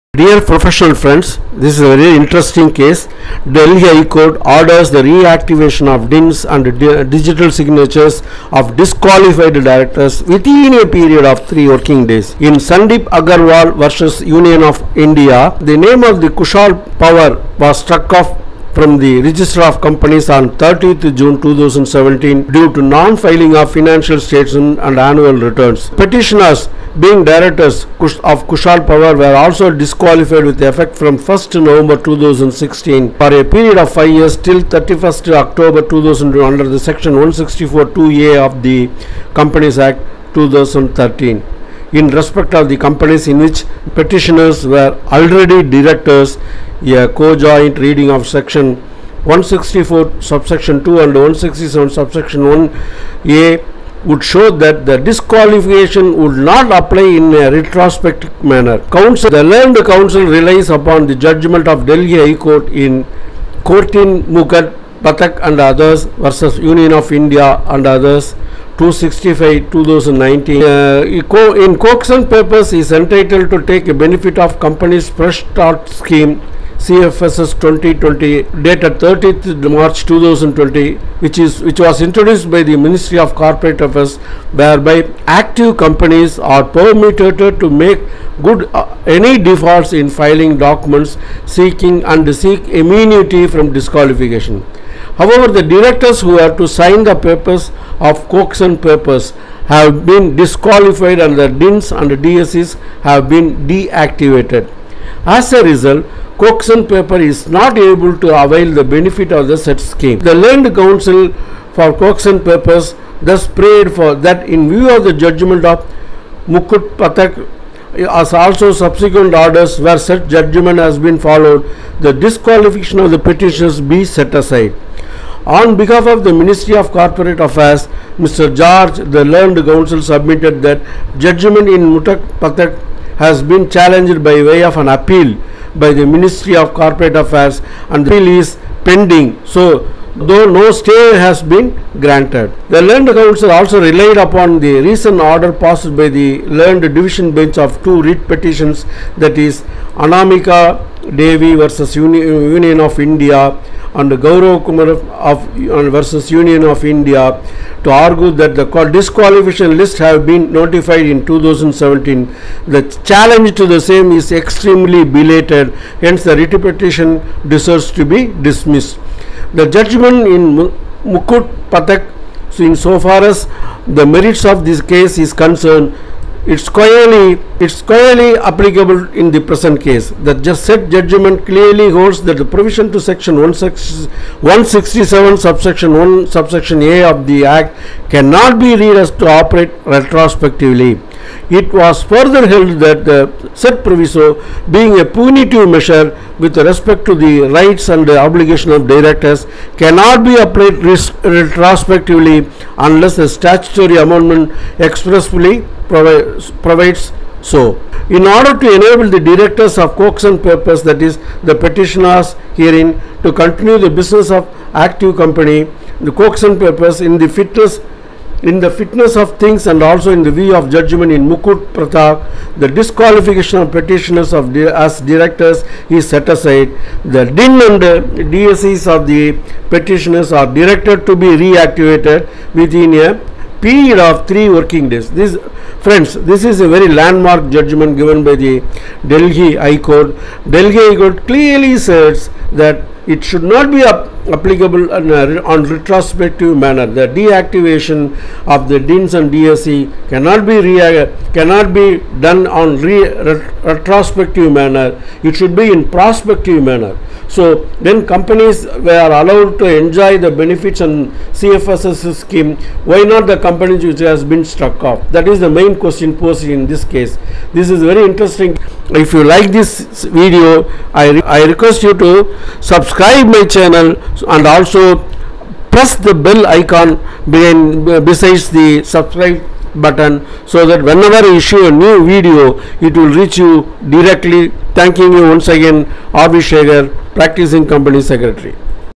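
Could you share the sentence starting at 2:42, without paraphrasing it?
The challenge to the same is extremely belated, hence the writ petition deserves to be dismissed.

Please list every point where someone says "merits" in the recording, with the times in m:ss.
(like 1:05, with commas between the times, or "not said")
2:54.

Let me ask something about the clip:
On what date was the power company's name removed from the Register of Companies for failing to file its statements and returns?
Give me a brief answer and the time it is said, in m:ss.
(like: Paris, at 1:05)
30 June 2017, at 0:20.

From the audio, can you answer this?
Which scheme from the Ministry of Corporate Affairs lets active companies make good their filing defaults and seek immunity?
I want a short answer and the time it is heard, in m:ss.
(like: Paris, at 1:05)
Company's Fresh Start Scheme, at 1:14.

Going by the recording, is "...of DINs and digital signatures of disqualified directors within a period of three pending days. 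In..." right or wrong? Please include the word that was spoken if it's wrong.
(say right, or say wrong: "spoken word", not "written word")
wrong: "working", not "pending".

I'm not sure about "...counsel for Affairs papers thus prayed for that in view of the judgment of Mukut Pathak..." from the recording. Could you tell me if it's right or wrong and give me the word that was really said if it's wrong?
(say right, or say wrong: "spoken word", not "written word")
wrong: "Koksun", not "Affairs".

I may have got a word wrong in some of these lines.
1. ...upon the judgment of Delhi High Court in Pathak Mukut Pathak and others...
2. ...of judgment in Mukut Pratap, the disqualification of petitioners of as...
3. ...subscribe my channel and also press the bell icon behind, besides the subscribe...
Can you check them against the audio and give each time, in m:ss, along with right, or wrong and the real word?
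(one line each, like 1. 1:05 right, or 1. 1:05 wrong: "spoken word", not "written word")
1. 1:00 wrong: "Courtin", not "Pathak"
2. 3:40 right
3. 4:32 right.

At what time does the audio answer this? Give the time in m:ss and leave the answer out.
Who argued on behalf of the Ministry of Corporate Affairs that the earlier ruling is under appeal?
2:08.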